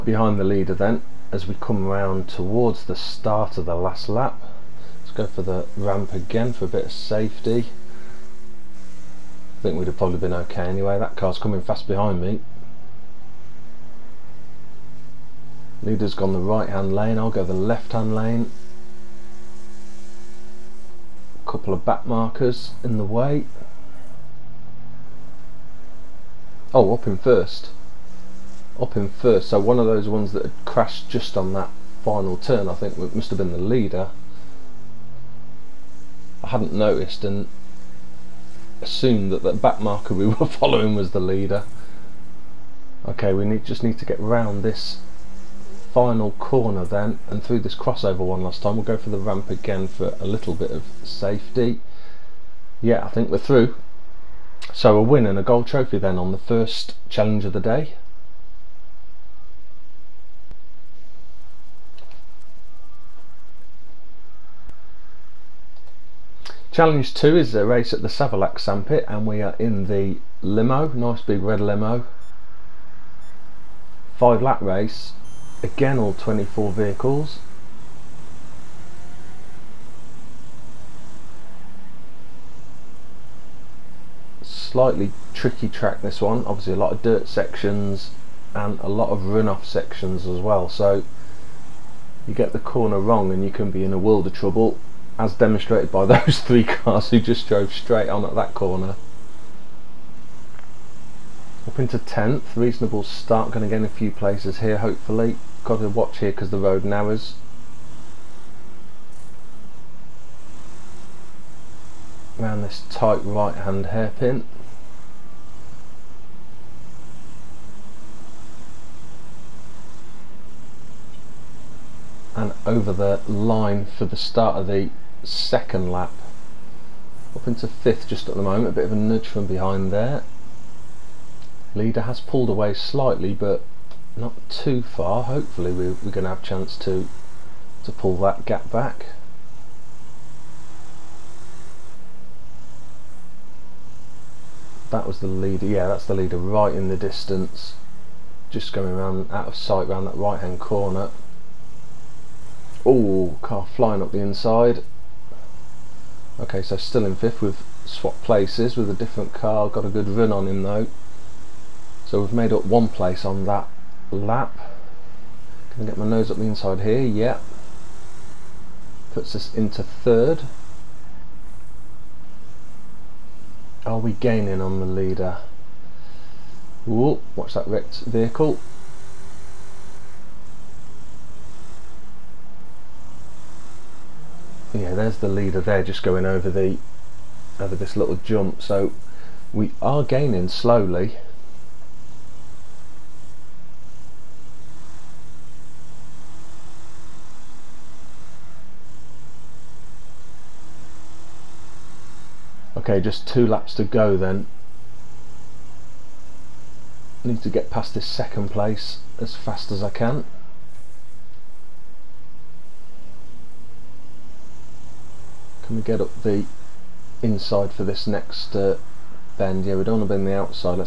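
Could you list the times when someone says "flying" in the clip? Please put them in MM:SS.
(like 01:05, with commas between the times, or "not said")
02:33.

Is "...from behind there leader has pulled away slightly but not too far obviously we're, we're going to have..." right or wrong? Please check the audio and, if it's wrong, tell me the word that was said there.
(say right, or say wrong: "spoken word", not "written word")
wrong: "hopefully", not "obviously".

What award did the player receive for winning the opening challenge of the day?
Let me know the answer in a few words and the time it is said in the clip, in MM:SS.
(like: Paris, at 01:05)
Gold trophy, at 00:55.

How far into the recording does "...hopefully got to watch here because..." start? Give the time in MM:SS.
01:44.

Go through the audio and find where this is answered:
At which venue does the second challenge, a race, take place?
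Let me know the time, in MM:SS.
01:08.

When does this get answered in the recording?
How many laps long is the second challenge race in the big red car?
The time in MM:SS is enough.
01:14.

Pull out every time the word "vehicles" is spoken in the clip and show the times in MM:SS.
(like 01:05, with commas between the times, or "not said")
01:16, 02:58.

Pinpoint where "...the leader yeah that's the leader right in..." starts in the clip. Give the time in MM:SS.
02:25.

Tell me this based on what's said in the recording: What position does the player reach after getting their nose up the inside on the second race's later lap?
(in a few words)
Third.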